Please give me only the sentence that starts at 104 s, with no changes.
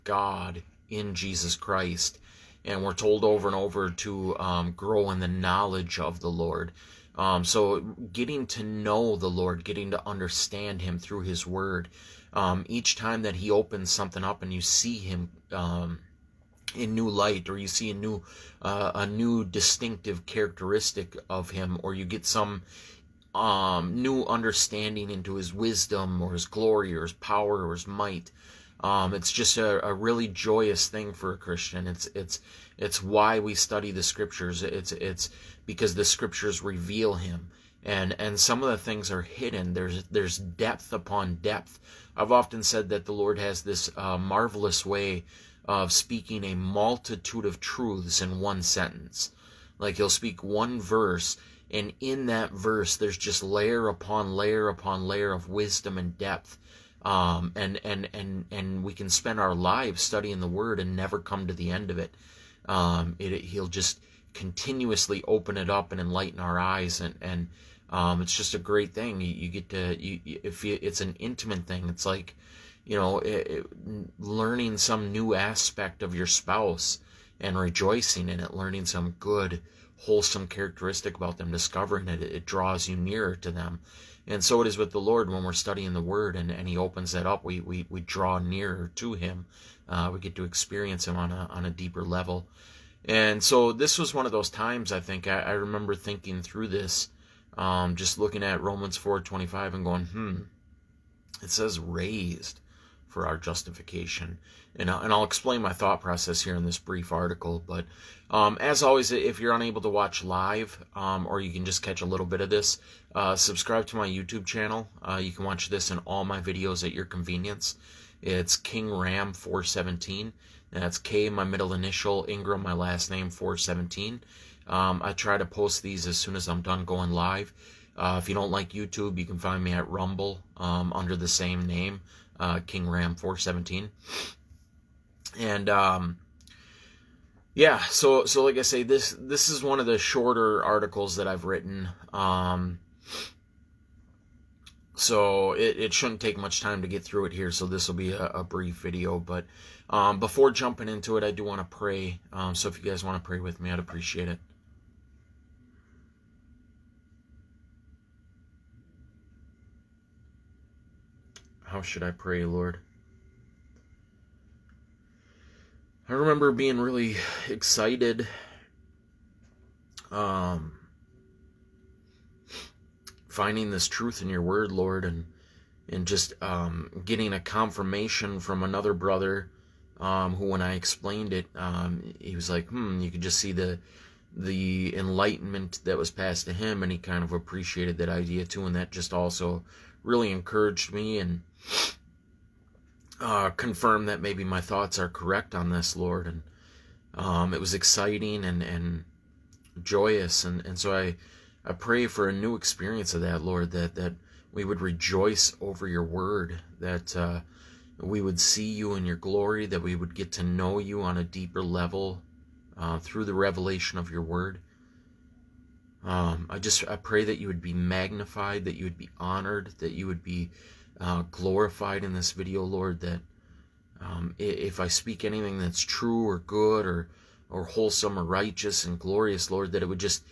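And, I'll, and I'll explain my thought process here in this brief article.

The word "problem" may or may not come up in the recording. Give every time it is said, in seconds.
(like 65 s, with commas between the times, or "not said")
not said.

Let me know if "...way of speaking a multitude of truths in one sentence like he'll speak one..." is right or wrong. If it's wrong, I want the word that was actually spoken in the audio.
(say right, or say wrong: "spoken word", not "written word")
right.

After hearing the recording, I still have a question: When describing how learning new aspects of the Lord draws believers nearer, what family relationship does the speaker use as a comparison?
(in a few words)
spouse.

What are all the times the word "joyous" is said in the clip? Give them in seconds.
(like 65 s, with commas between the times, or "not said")
30 s, 199 s.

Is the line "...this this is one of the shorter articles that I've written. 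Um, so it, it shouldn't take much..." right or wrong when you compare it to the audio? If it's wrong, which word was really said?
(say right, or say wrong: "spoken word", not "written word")
right.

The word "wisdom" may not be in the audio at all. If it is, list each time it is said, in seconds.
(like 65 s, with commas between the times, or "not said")
25 s, 55 s.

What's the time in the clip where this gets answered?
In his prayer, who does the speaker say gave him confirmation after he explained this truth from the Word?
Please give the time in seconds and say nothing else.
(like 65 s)
178 s.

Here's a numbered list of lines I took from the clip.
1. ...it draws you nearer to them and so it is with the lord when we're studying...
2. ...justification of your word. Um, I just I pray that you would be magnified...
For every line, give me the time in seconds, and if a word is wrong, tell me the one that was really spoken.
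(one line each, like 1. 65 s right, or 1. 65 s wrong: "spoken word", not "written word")
1. 82 s right
2. 213 s wrong: "revelation", not "justification".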